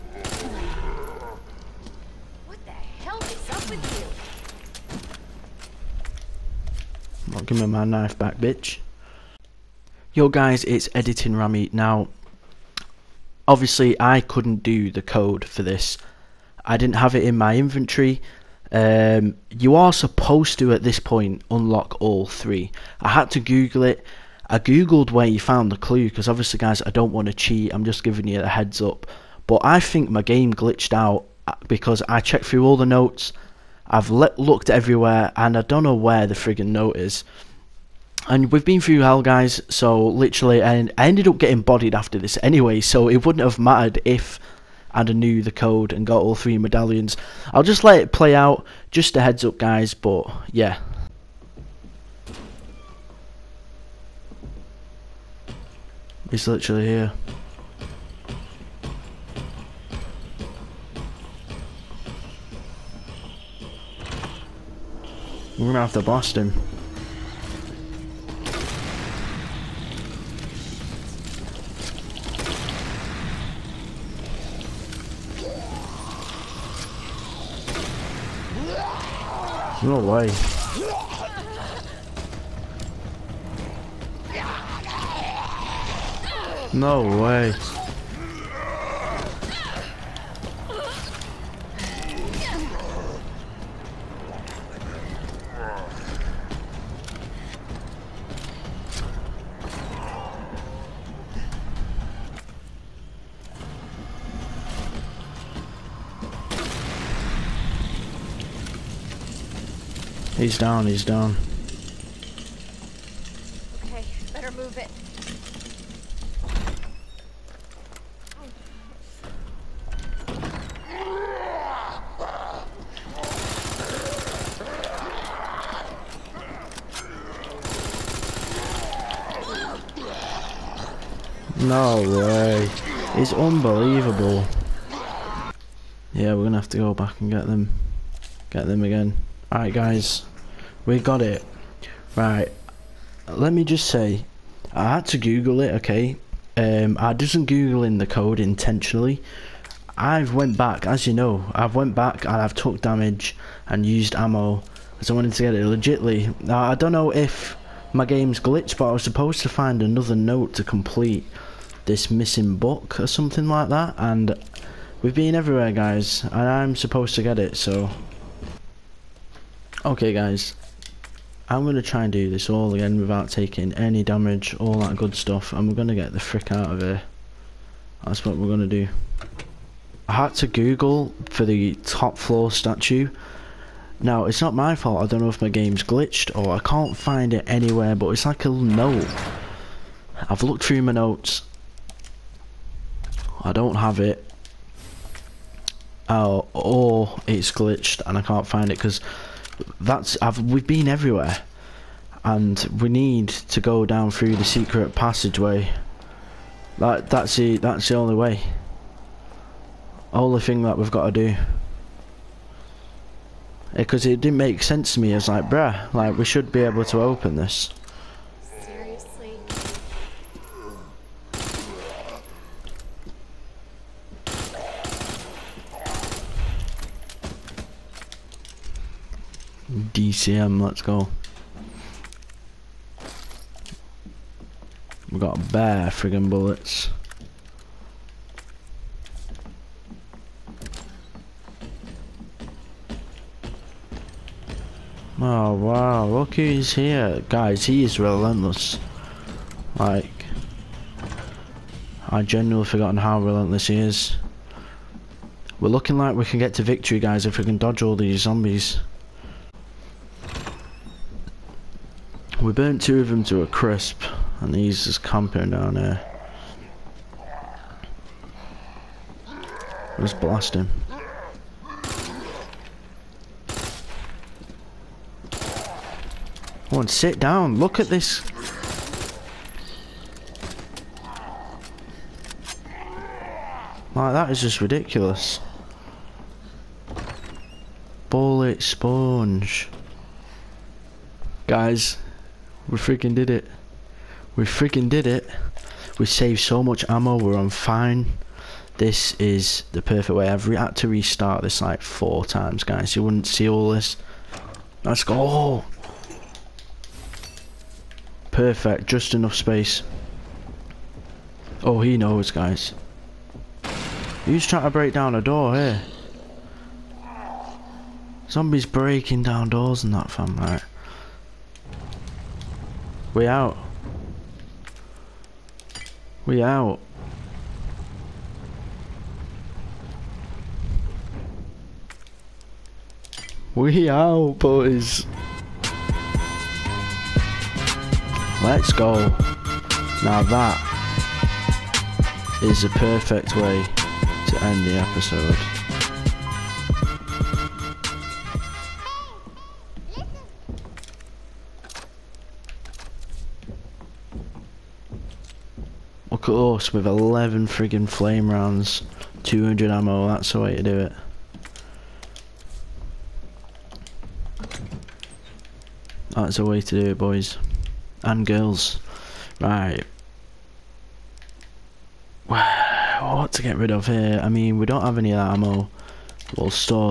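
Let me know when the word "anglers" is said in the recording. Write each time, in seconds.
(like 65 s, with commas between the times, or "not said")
not said.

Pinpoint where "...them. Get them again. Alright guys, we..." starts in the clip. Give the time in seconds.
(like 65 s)
137 s.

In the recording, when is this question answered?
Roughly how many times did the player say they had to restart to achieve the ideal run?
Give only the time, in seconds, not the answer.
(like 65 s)
301 s.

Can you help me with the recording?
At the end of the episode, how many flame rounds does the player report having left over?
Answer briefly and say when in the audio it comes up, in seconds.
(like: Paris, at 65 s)
11, at 356 s.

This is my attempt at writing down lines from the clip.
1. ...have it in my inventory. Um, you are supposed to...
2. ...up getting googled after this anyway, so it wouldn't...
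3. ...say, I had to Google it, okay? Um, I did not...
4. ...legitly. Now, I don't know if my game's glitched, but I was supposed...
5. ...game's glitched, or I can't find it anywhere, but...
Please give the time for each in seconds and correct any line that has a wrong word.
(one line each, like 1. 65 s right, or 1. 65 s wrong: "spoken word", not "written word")
1. 16 s right
2. 41 s wrong: "bodied", not "googled"
3. 143 s right
4. 155 s right
5. 185 s right.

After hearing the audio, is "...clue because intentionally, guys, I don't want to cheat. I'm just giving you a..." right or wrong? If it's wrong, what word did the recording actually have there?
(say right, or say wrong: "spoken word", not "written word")
wrong: "obviously", not "intentionally".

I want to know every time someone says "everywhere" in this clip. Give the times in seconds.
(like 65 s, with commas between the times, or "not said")
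34 s, 165 s, 200 s.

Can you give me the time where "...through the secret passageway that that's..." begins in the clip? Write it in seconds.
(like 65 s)
204 s.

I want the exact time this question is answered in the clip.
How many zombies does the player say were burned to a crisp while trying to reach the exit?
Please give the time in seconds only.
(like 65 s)
262 s.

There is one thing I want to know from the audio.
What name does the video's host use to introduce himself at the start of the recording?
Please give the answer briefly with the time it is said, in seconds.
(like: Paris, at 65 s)
Editing Rammy, at 10 s.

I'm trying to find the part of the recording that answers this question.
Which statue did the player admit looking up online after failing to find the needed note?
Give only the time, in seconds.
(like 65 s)
181 s.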